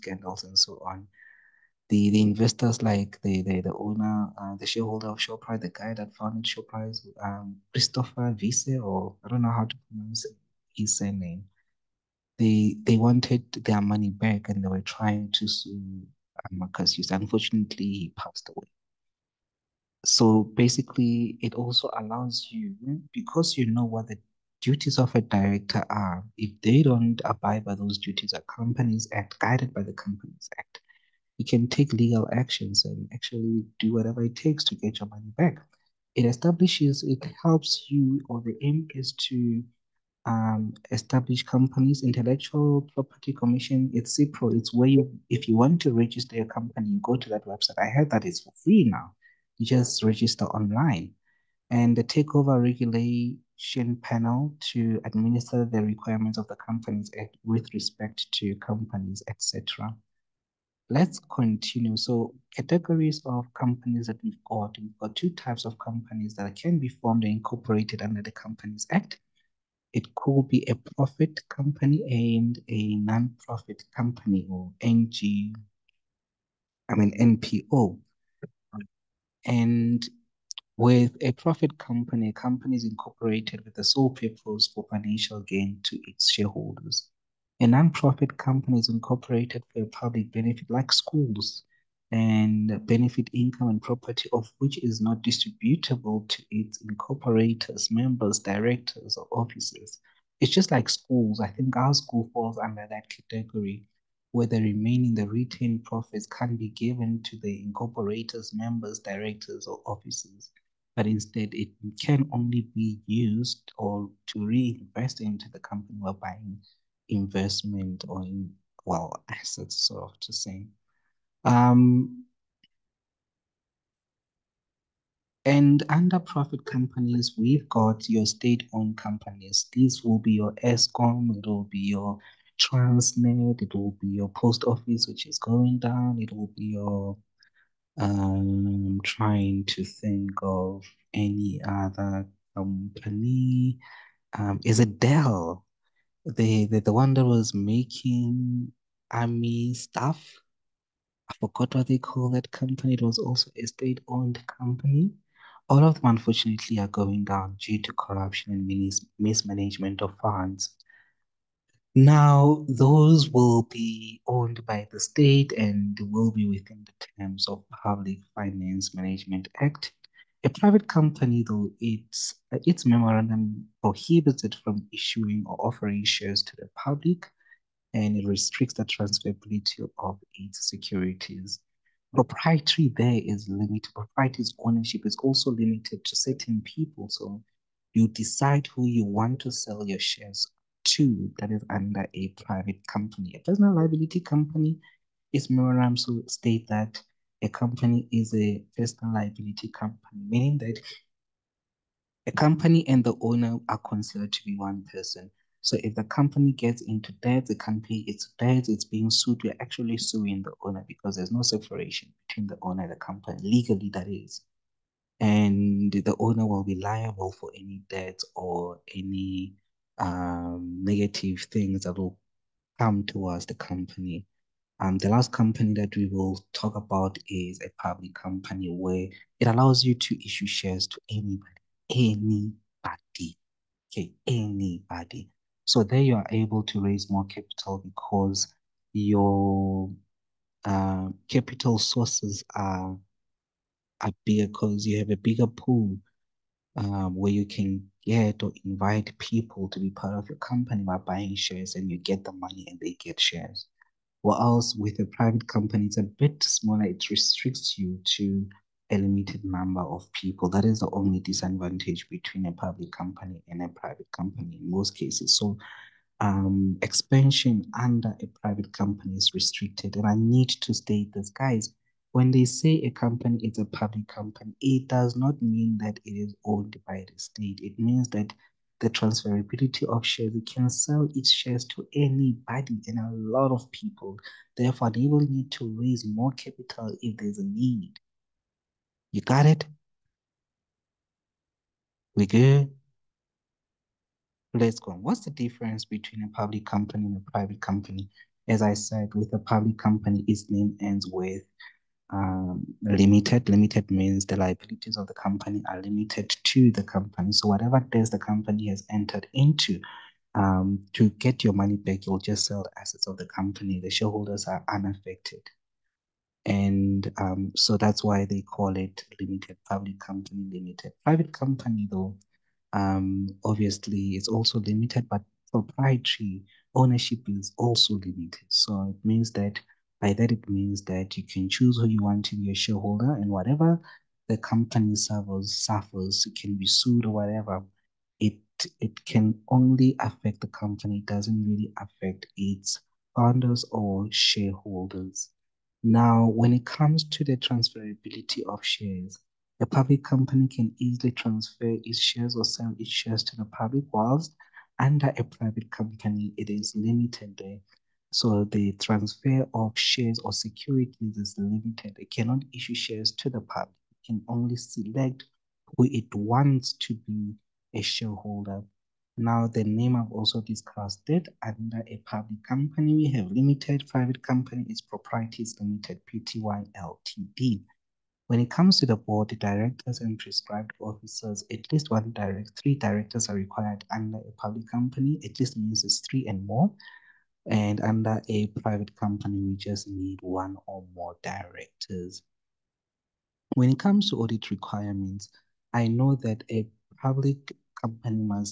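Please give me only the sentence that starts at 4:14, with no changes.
Or else with a private company, it's a bit smaller.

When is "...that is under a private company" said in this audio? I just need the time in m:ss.
3:11.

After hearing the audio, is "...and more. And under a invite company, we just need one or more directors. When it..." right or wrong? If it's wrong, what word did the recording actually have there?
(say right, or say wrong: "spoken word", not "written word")
wrong: "private", not "invite".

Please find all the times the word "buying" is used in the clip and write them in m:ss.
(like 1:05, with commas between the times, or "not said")
1:56, 4:10.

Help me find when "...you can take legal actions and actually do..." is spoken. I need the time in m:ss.
0:31.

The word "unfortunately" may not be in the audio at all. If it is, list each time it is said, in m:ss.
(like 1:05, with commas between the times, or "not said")
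0:17, 2:36.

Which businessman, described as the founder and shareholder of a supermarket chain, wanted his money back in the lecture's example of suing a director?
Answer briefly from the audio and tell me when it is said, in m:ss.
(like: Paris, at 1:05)
Christopher Wiese, at 0:07.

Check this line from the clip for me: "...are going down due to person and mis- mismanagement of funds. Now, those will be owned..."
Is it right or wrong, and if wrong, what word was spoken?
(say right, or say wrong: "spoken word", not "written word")
wrong: "corruption", not "person".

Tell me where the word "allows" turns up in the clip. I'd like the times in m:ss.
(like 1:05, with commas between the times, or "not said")
0:21, 3:49.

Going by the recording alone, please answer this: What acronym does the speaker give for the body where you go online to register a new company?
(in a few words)
CIPRO.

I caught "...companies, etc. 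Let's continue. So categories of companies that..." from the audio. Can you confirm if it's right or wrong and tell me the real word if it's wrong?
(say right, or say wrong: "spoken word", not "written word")
right.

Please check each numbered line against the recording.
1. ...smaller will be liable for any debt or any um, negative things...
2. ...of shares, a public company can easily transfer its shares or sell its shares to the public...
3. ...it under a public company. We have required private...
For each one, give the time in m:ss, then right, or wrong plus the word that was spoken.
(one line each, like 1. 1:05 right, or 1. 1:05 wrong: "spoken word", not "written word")
1. 3:36 wrong: "owner", not "smaller"
2. 5:48 right
3. 6:11 wrong: "limited", not "required".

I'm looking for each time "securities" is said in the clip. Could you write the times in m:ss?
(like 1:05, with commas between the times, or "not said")
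3:00, 6:00.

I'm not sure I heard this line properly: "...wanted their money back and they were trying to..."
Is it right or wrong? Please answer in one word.
right.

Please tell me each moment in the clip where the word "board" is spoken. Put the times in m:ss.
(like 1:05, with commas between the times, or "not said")
6:18.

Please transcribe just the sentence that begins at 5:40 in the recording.
It doesn't really affect its founders or shareholders.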